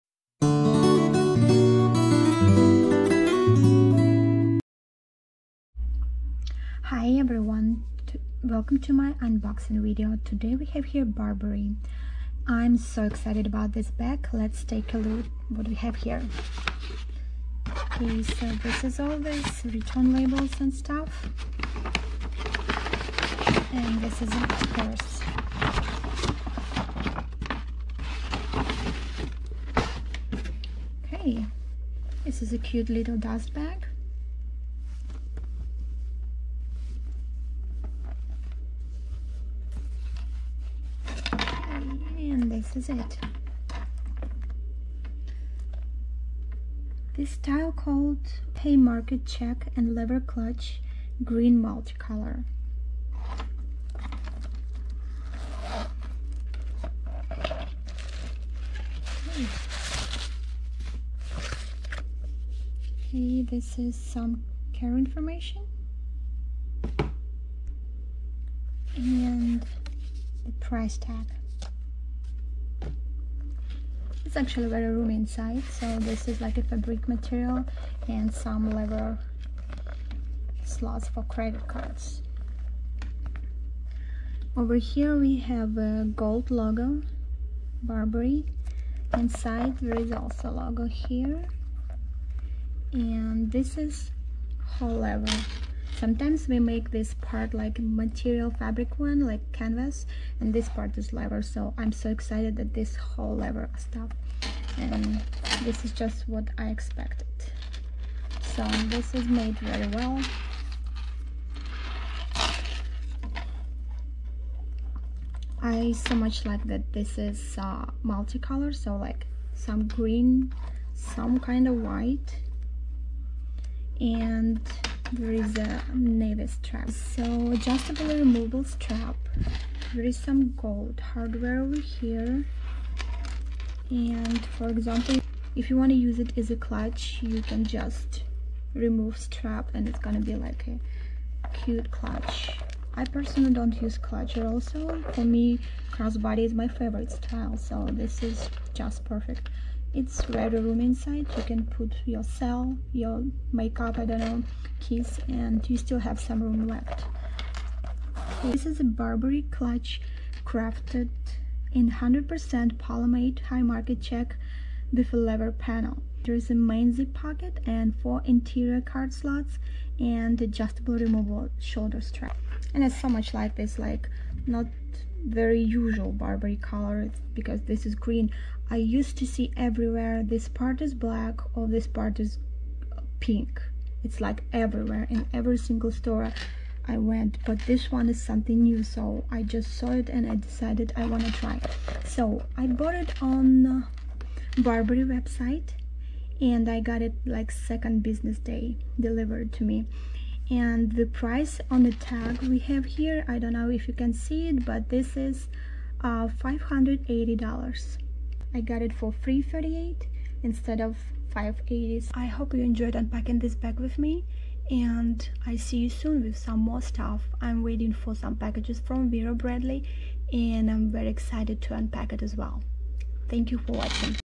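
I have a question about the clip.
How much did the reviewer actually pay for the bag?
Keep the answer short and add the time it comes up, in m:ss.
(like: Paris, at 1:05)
$338, at 3:29.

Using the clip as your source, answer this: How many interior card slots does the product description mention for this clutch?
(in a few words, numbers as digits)
4.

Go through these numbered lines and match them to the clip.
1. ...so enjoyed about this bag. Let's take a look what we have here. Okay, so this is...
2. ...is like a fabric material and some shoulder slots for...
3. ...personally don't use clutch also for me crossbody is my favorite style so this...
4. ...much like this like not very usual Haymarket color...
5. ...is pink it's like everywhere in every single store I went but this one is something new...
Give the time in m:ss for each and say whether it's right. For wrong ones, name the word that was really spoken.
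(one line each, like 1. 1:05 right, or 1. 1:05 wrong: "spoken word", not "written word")
1. 0:12 wrong: "excited", not "enjoyed"
2. 1:16 wrong: "leather", not "shoulder"
3. 2:23 right
4. 2:53 wrong: "Burberry", not "Haymarket"
5. 3:02 right.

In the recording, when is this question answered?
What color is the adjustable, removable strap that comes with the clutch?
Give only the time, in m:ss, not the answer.
2:05.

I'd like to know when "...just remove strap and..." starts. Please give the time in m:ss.
2:17.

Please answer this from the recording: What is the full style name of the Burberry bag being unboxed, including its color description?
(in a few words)
Haymarket Check and Lever Clutch Green Multicolor.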